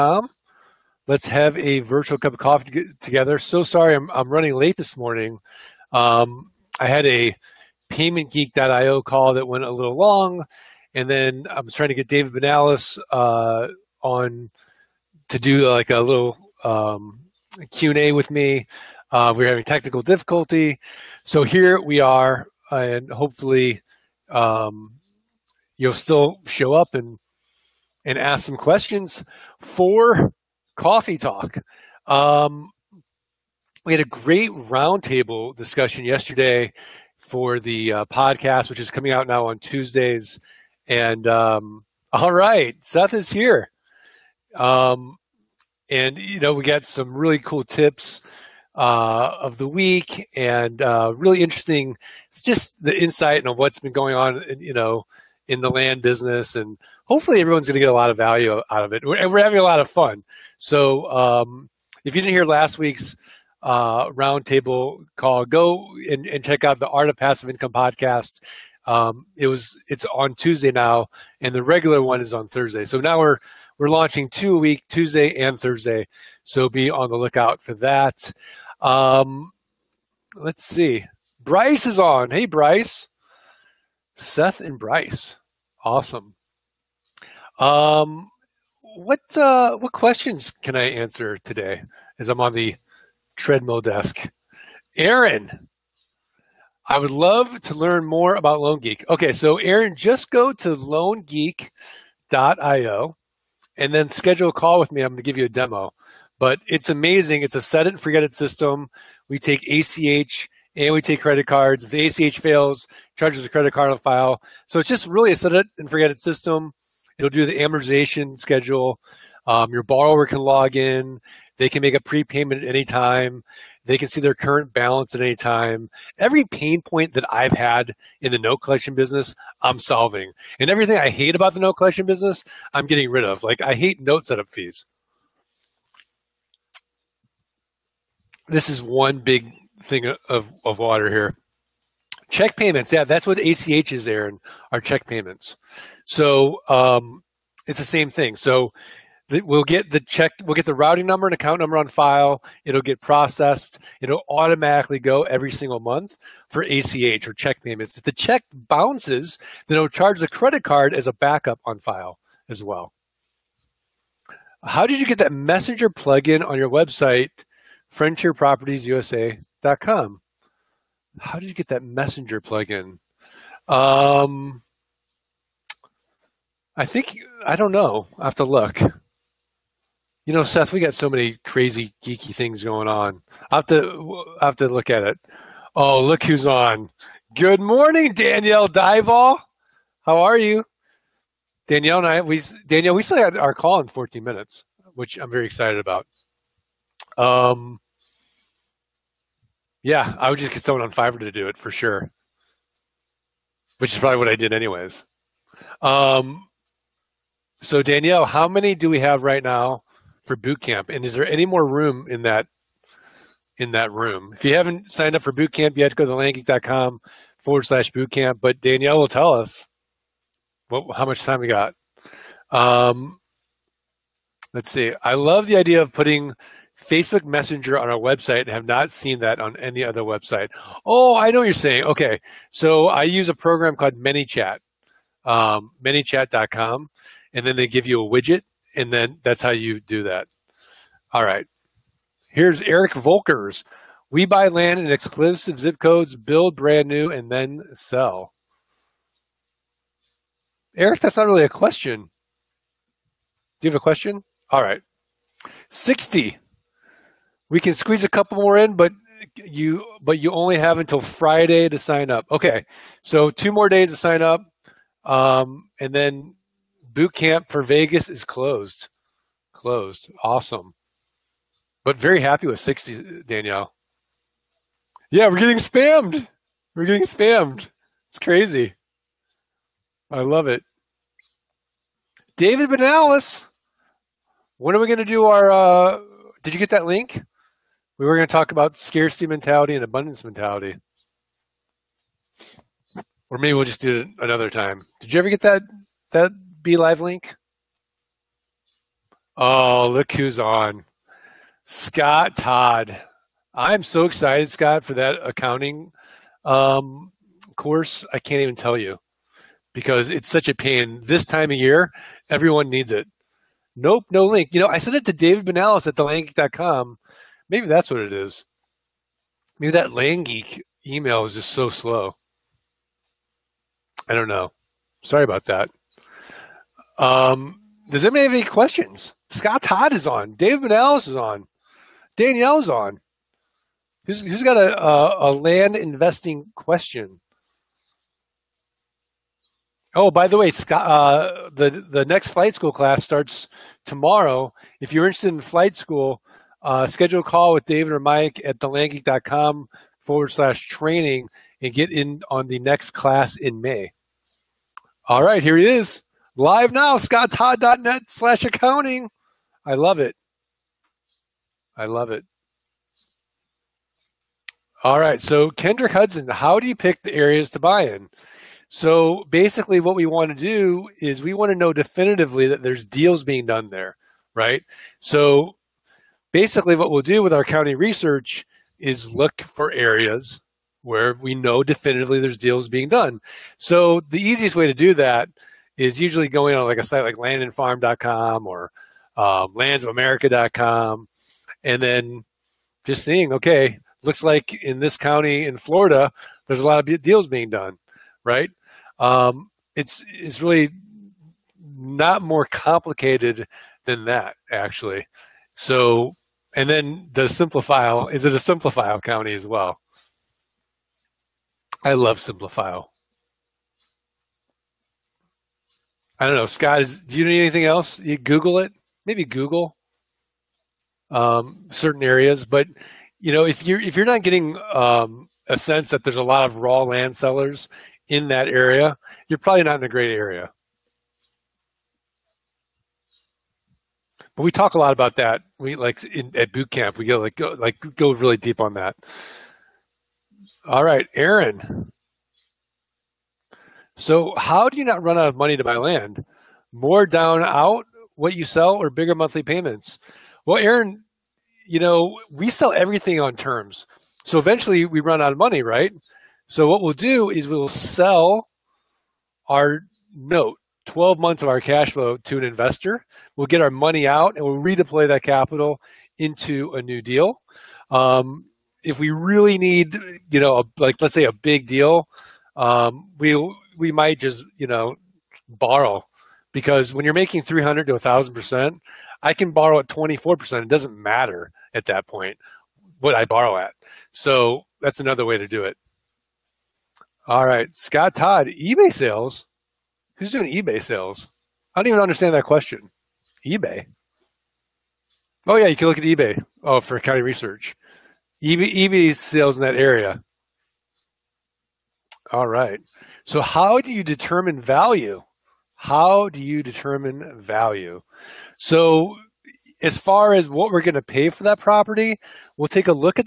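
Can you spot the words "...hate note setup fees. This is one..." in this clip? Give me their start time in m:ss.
2:13.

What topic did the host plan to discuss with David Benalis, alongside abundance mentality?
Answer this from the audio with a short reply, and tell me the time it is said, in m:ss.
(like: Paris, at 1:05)
Scarcity mentality, at 4:48.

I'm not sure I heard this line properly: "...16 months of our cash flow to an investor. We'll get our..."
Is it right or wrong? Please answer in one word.
wrong.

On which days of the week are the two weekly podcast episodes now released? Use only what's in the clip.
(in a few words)
Tuesday and Thursday.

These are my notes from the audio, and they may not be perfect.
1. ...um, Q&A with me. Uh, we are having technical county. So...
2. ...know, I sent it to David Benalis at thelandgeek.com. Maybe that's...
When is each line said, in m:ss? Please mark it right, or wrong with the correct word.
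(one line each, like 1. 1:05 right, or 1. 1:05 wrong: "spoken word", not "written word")
1. 0:16 wrong: "difficulty", not "county"
2. 5:14 right.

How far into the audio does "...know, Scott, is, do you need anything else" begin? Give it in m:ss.
6:56.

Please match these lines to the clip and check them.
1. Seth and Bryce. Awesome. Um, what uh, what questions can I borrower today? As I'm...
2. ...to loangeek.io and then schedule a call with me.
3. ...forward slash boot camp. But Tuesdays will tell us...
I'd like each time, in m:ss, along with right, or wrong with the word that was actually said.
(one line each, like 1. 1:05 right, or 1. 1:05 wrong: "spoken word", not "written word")
1. 1:24 wrong: "answer", not "borrower"
2. 1:40 right
3. 3:37 wrong: "Danielle", not "Tuesdays".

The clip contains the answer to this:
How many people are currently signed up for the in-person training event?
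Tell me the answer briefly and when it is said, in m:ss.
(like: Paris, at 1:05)
60, at 4:32.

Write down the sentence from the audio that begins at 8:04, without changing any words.
So that's another way to do it.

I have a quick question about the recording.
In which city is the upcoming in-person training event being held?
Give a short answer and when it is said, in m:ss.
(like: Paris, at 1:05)
Vegas, at 4:27.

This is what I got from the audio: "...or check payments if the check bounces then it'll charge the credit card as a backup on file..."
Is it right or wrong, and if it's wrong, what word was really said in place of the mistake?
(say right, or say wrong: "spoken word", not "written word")
right.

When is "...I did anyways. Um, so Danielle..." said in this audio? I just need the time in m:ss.
3:24.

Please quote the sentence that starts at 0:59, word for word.
We're, and we're having a lot of fun.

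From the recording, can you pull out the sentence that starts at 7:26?
More down out what you sell or bigger monthly payments?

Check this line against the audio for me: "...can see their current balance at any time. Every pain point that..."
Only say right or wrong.
right.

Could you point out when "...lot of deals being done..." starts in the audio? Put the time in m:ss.
6:36.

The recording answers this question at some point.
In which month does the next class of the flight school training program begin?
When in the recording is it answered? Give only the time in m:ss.
5:53.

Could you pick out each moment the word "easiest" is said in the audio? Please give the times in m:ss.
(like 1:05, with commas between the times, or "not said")
6:24.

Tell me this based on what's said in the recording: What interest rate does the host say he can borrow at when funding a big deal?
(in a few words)
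24 percent.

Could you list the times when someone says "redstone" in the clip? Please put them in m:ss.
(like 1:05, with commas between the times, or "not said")
not said.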